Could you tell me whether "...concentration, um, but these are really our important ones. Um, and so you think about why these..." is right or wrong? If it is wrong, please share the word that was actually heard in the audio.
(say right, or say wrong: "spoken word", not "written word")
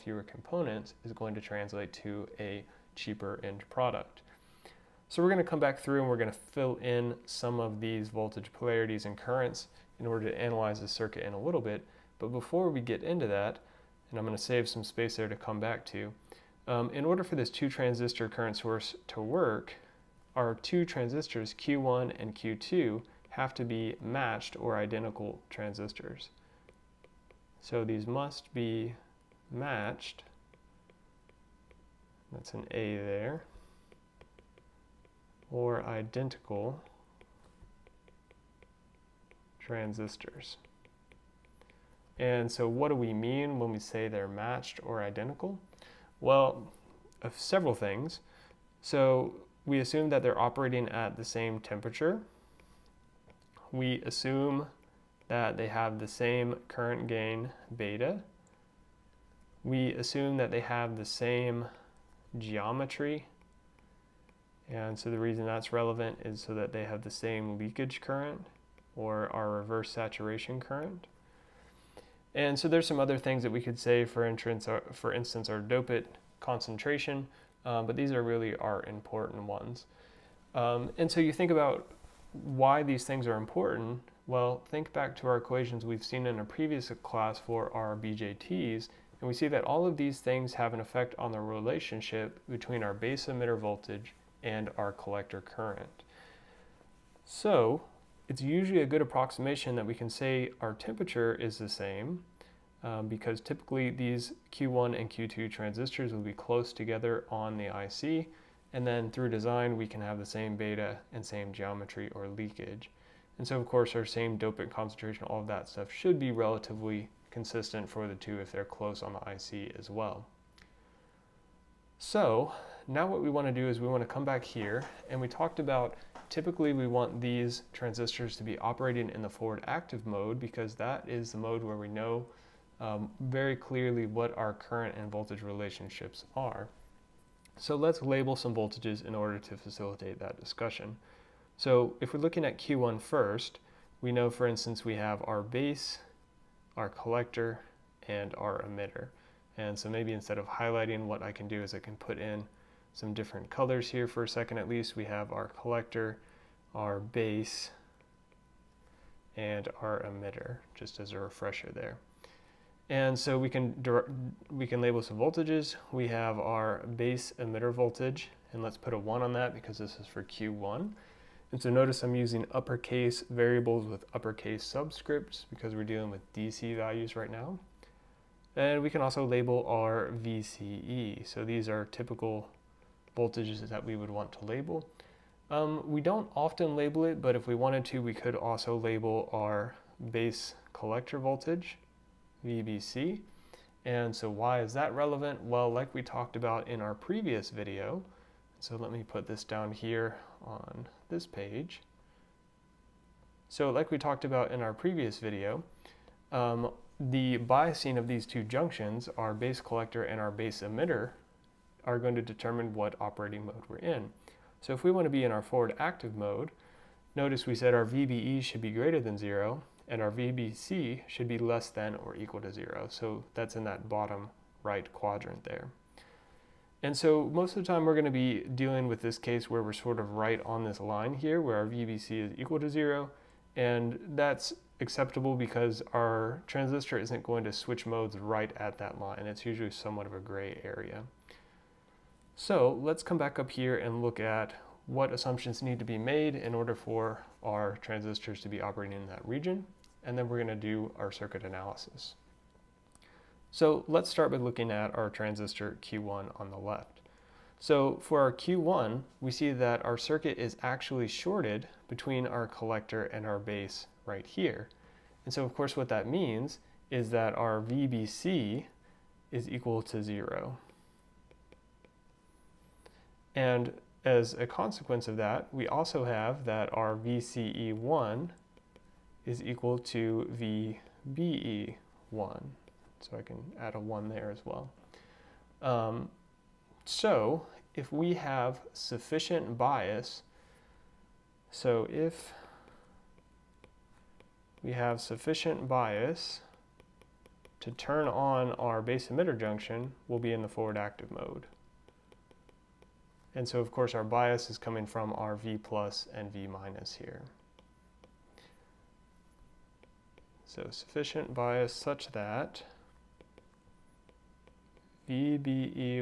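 right.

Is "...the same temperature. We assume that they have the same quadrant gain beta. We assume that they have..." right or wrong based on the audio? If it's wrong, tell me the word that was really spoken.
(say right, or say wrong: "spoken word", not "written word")
wrong: "current", not "quadrant".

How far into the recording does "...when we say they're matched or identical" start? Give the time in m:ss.
0:43.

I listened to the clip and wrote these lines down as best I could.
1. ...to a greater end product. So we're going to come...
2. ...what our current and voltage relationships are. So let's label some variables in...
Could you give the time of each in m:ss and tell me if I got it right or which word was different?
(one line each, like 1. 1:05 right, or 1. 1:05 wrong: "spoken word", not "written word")
1. 0:02 wrong: "cheaper", not "greater"
2. 2:14 wrong: "voltages", not "variables".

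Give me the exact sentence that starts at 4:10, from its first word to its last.
And then we're gonna do our circuit analysis.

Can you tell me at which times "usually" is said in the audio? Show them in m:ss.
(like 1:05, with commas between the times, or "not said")
1:38, 3:59.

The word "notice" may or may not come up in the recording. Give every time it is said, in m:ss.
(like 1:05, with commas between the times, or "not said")
2:51, 3:37.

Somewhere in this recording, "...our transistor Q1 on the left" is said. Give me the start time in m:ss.
4:14.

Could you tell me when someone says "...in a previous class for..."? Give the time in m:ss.
1:26.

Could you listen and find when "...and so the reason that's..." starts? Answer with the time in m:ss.
1:04.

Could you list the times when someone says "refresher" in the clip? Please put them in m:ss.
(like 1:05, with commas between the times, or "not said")
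2:41.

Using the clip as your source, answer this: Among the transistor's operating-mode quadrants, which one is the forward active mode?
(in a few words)
Bottom right.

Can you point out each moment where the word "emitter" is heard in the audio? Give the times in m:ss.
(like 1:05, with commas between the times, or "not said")
1:33, 2:28, 2:40, 2:47, 3:30, 4:59.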